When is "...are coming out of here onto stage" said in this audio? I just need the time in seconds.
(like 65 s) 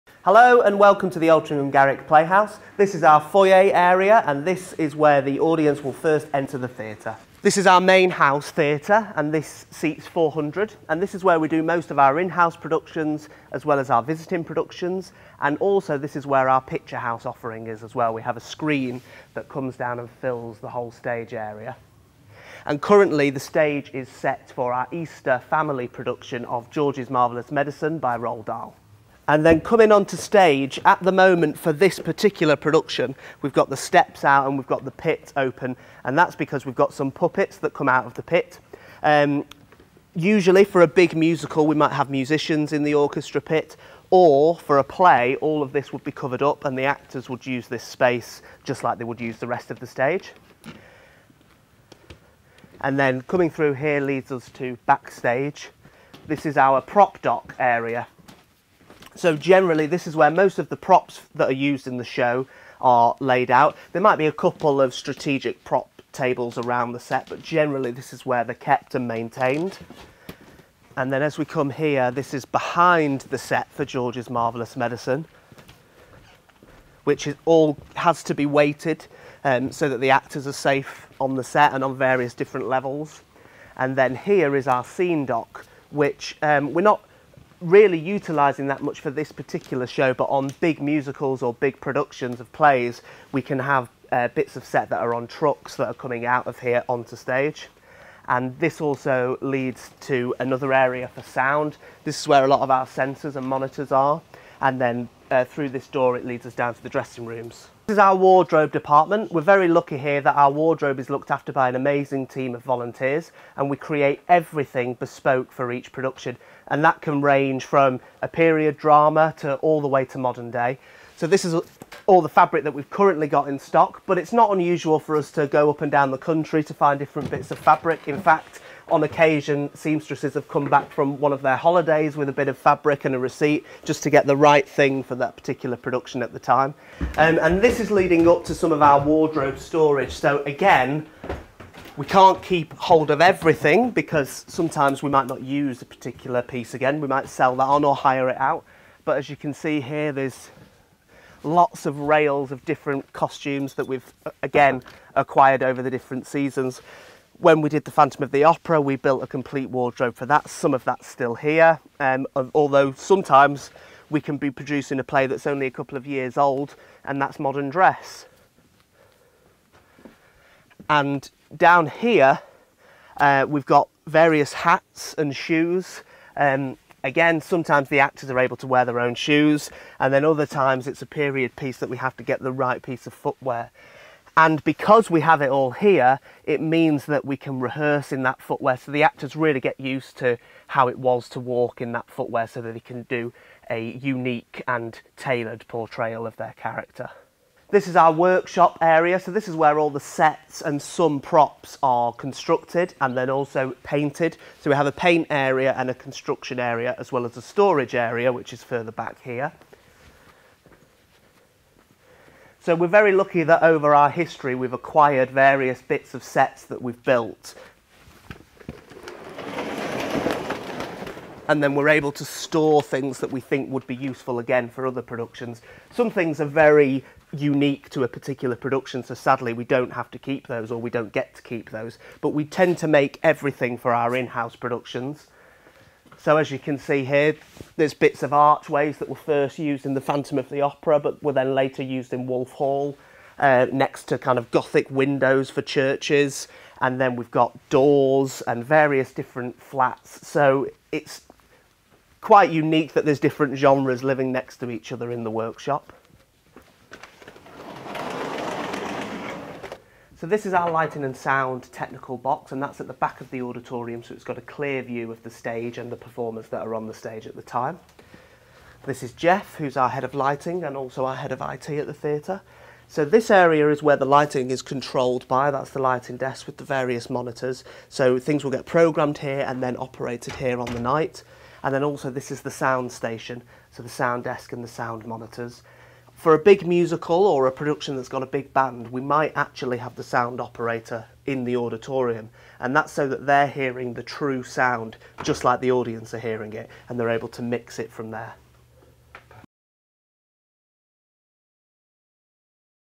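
95 s.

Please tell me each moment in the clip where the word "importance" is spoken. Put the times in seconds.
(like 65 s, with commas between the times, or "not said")
not said.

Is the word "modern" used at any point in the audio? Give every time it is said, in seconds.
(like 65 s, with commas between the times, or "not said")
120 s, 167 s.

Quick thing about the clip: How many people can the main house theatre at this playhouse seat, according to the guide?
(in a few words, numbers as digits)
400.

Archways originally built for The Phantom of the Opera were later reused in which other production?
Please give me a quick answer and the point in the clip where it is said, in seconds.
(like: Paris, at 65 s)
Wolf Hall, at 242 s.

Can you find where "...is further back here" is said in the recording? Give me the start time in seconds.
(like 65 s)
208 s.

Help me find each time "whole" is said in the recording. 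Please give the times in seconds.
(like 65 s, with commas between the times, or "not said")
20 s.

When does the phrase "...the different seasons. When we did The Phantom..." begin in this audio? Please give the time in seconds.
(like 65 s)
155 s.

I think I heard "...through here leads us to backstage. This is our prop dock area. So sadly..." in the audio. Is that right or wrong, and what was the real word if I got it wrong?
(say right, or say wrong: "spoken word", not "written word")
wrong: "generally", not "sadly".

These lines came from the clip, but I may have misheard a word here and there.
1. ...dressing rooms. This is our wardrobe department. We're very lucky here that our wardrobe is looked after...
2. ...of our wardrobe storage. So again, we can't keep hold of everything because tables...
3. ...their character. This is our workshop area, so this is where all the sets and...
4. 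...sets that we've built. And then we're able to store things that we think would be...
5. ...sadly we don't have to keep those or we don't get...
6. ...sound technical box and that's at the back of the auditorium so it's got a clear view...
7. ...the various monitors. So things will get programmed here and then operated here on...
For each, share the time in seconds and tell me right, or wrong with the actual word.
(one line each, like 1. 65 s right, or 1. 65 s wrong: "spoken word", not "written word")
1. 106 s right
2. 138 s wrong: "sometimes", not "tables"
3. 196 s right
4. 216 s right
5. 229 s right
6. 261 s right
7. 276 s right.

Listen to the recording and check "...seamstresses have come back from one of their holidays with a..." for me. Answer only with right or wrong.
right.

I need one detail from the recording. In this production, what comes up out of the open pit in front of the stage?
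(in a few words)
Puppets.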